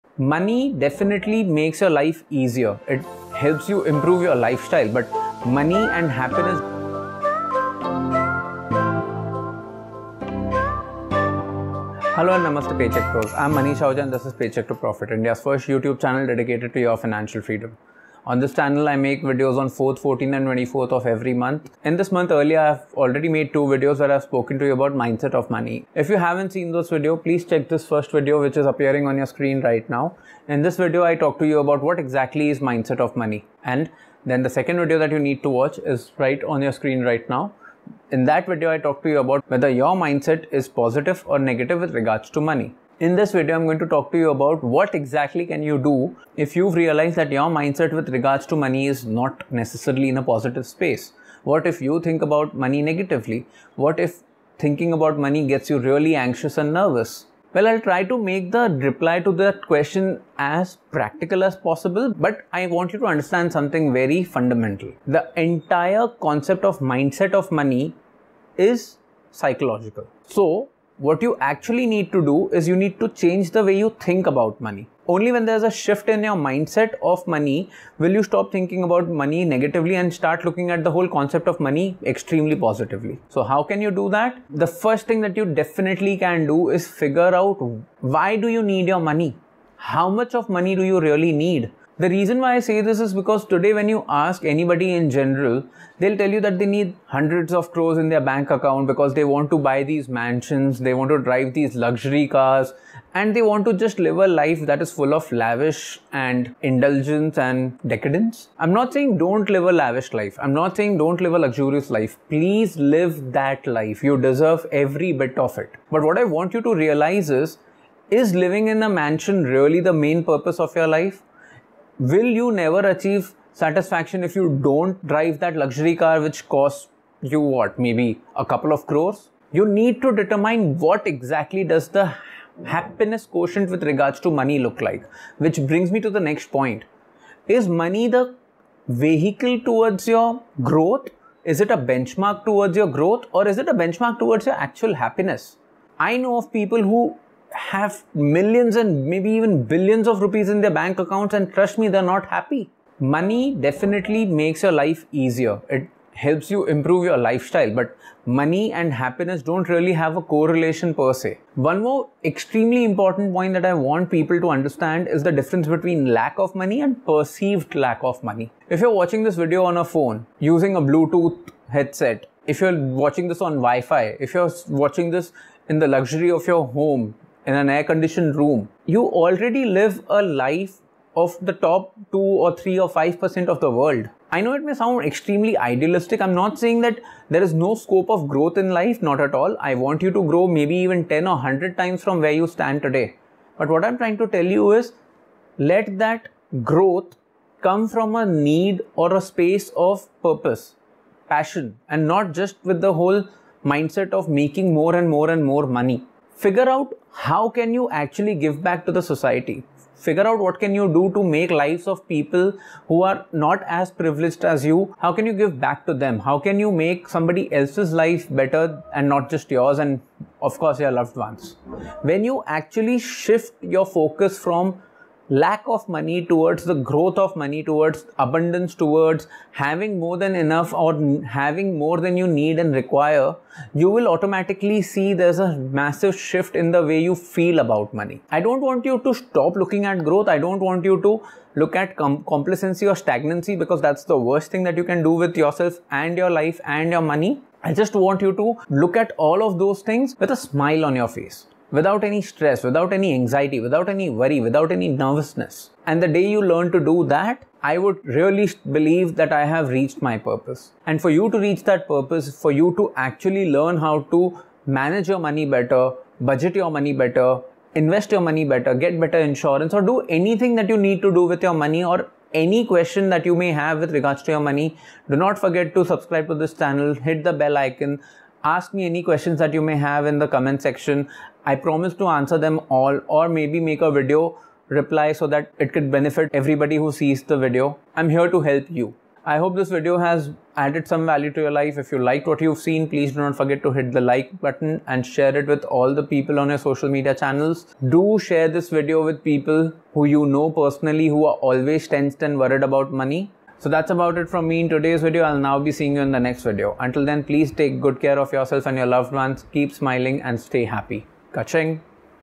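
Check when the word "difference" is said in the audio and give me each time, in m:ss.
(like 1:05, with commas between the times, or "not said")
2:45.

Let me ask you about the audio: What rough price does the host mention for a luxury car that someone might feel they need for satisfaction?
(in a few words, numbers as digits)
A couple of crores.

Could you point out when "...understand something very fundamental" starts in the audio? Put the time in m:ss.
1:03.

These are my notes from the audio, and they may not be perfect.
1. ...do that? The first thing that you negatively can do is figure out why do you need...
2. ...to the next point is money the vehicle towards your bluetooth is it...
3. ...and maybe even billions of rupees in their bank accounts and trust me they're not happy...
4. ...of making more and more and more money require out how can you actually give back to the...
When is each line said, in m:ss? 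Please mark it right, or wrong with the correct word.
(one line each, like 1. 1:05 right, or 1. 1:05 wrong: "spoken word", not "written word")
1. 1:23 wrong: "definitely", not "negatively"
2. 2:15 wrong: "growth", not "bluetooth"
3. 2:28 right
4. 3:24 wrong: "figure", not "require".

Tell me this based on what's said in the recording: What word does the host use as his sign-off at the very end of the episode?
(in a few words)
Kaching.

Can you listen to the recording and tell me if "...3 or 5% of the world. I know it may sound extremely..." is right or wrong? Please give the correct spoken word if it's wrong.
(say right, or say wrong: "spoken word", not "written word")
right.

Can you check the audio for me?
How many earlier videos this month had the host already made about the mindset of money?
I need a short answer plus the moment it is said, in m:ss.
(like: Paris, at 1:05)
2, at 0:23.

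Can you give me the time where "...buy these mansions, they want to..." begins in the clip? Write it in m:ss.
1:39.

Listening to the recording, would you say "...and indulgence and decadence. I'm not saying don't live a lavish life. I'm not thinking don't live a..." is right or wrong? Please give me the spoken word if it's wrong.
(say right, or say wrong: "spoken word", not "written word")
wrong: "saying", not "thinking".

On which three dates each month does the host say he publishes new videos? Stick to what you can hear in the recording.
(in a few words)
4th, 14th and 24th.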